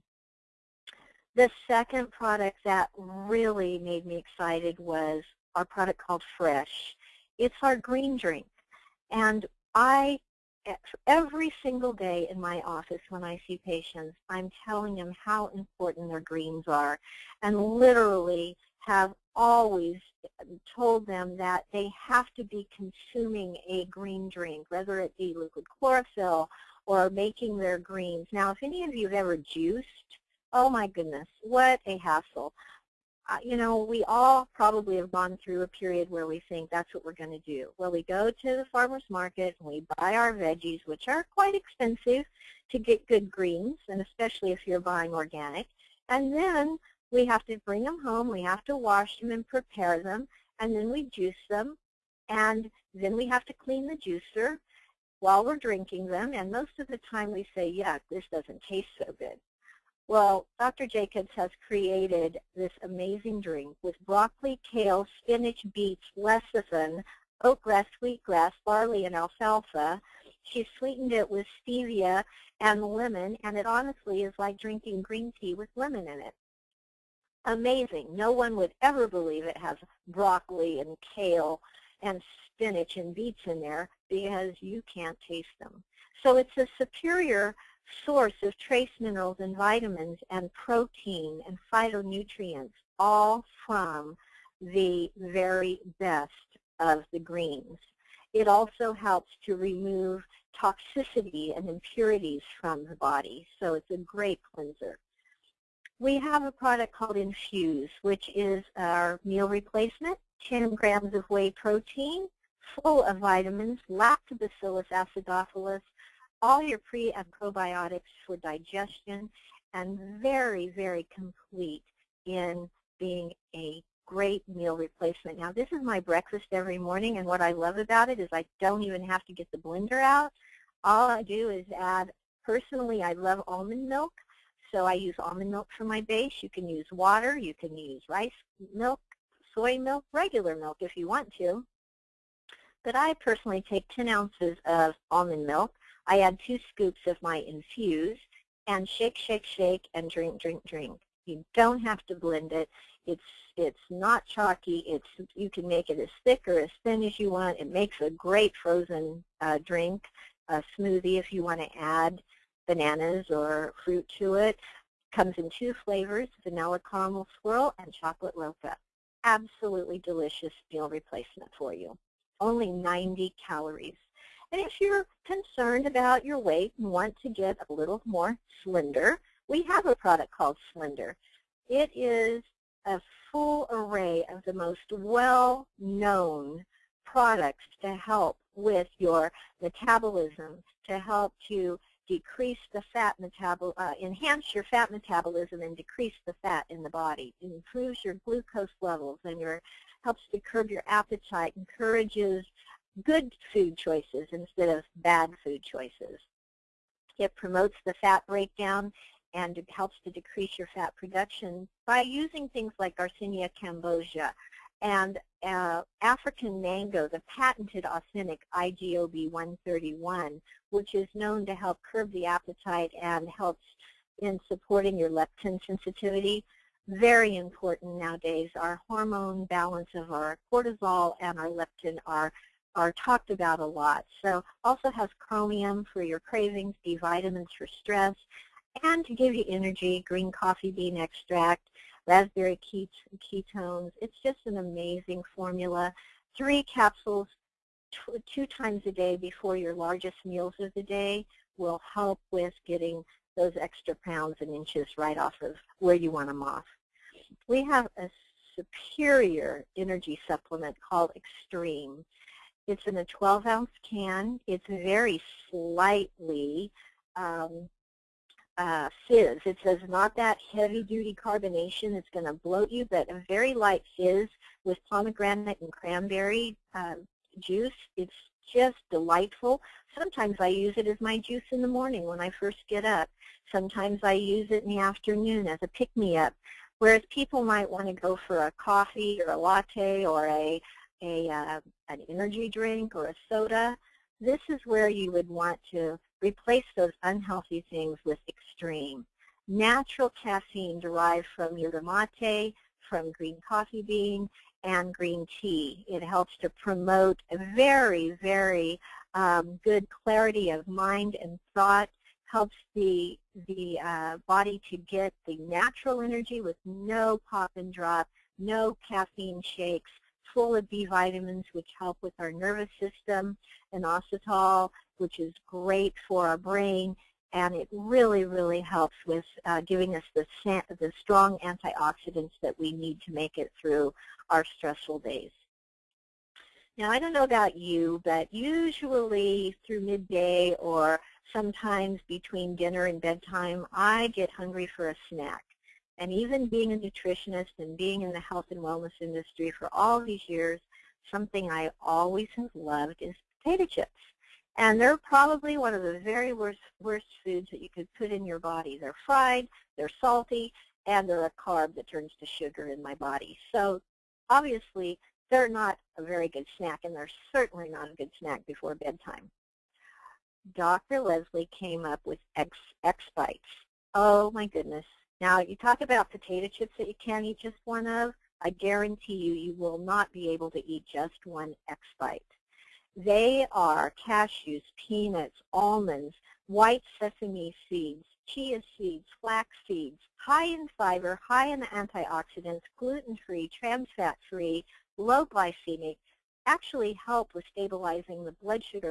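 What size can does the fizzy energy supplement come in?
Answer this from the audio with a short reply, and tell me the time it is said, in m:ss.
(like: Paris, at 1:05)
12-ounce, at 4:23.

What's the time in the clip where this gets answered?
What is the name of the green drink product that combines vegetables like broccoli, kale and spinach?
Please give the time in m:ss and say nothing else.
0:06.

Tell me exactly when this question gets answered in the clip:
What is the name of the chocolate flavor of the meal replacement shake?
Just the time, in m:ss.
2:47.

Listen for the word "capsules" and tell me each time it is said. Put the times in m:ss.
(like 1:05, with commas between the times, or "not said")
4:06.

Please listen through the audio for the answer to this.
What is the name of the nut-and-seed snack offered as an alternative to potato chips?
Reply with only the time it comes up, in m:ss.
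6:12.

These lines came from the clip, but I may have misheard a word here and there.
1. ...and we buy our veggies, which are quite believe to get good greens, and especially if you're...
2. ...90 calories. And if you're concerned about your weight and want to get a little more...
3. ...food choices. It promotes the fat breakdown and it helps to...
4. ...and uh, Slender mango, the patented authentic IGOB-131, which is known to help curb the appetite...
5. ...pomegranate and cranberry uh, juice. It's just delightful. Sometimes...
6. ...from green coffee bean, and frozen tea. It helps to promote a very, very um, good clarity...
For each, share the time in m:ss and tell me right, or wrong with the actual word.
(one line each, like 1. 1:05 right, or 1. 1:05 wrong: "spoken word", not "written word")
1. 0:39 wrong: "expensive", not "believe"
2. 2:52 right
3. 3:25 right
4. 3:34 wrong: "African", not "Slender"
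5. 4:34 right
6. 5:02 wrong: "green", not "frozen".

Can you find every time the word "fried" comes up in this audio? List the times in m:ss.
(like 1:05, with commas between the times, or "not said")
5:59.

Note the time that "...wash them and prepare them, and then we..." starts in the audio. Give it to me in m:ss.
0:48.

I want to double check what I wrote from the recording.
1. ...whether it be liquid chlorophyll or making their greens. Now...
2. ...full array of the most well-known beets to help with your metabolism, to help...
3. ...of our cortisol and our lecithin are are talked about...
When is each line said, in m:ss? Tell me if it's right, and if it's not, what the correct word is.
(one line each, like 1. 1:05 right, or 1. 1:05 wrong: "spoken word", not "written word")
1. 0:24 right
2. 3:03 wrong: "products", not "beets"
3. 3:49 wrong: "leptin", not "lecithin".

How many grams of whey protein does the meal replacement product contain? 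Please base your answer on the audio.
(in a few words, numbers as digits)
10.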